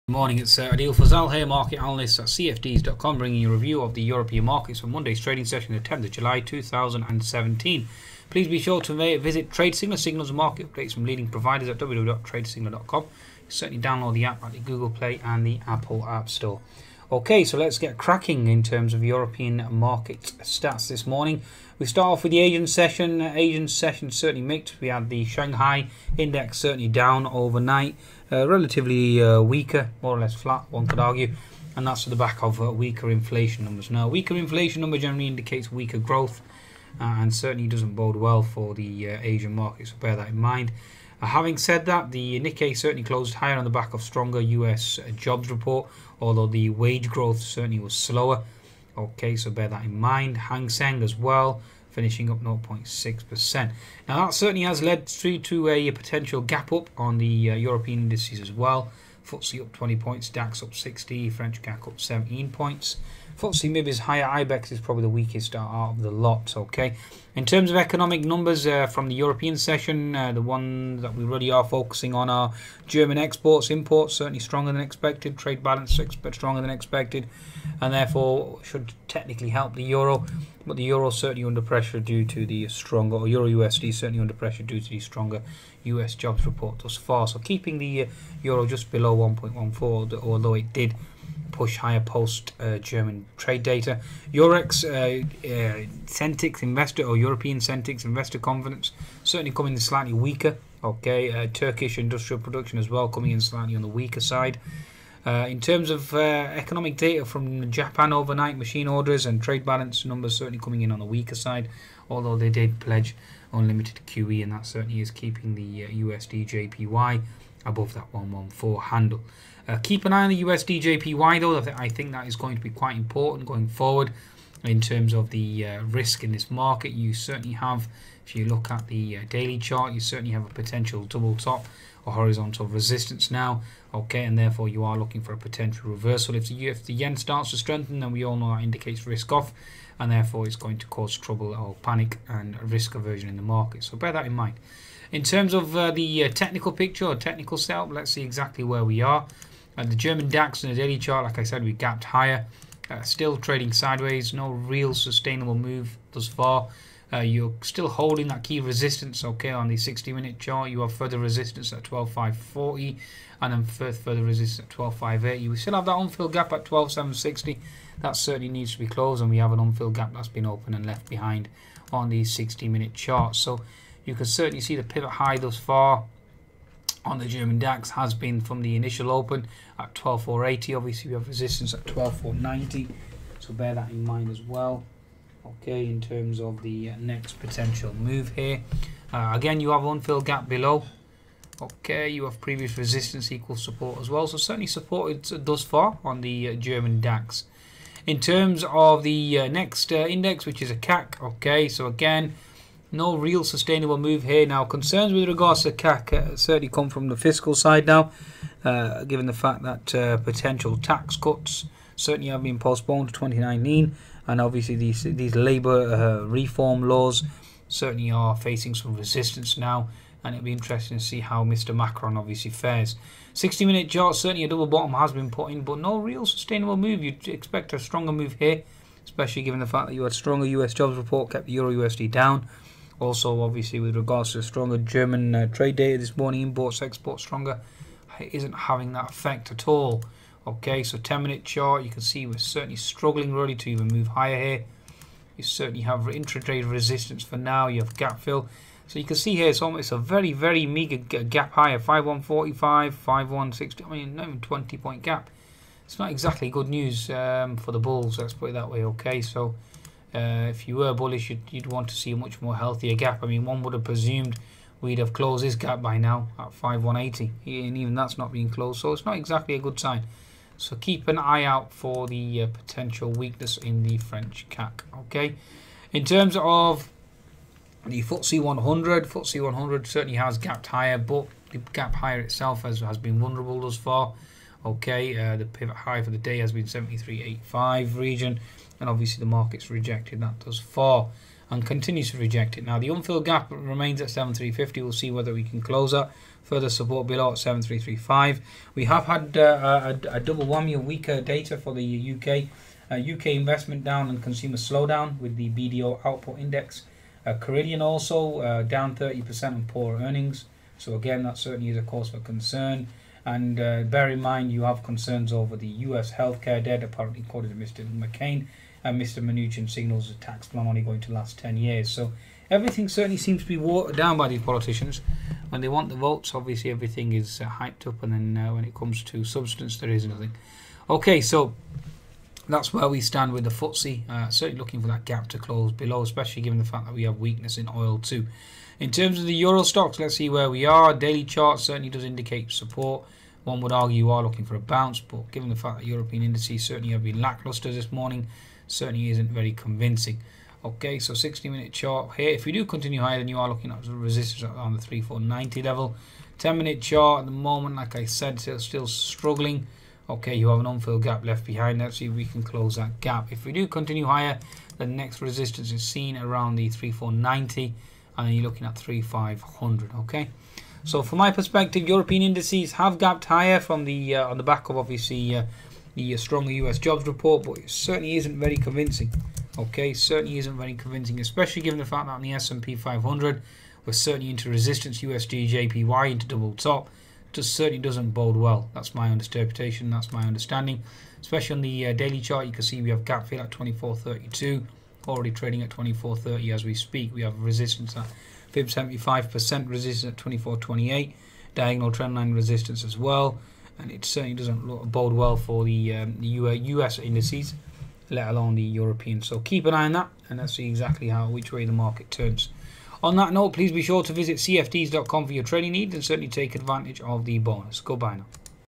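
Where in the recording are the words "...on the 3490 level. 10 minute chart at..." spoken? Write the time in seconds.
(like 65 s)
354 s.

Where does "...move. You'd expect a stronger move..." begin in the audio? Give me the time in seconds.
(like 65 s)
226 s.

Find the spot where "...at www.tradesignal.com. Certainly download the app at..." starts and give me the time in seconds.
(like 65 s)
11 s.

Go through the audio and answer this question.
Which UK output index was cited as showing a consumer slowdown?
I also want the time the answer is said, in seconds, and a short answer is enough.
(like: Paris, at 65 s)
BDO output index, at 305 s.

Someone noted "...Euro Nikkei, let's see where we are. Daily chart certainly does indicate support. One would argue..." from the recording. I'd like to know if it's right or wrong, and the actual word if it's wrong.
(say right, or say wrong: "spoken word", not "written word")
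wrong: "Stoxx", not "Nikkei".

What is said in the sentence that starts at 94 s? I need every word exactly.
Eurex, uh, uh, Sentix Investor or European Sentix Investor Confidence certainly coming in slightly weaker.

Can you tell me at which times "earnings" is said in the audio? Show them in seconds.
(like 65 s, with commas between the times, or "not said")
310 s.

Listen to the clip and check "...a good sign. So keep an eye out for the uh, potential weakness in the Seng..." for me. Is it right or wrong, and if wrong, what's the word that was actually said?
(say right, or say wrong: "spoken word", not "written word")
wrong: "French", not "Seng".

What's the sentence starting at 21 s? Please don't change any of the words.
We start off with the Asian session.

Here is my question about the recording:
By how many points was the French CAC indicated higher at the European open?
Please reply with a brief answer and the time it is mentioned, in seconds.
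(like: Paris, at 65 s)
17, at 62 s.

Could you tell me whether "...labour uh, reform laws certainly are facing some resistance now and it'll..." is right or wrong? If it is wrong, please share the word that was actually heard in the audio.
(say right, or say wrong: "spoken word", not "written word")
right.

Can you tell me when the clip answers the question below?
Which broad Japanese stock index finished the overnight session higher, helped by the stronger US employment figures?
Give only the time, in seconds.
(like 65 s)
42 s.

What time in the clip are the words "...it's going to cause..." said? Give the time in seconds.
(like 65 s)
140 s.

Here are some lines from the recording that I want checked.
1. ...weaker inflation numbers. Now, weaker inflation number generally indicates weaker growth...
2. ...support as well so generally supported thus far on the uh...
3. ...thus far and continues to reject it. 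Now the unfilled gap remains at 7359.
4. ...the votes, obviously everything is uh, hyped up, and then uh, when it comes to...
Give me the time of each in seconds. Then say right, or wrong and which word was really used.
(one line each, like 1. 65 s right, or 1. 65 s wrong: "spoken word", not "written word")
1. 32 s right
2. 193 s wrong: "certainly", not "generally"
3. 290 s wrong: "7350", not "7359"
4. 325 s right.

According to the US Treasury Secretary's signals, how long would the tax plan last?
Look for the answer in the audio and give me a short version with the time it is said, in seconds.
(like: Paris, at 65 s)
10 years, at 321 s.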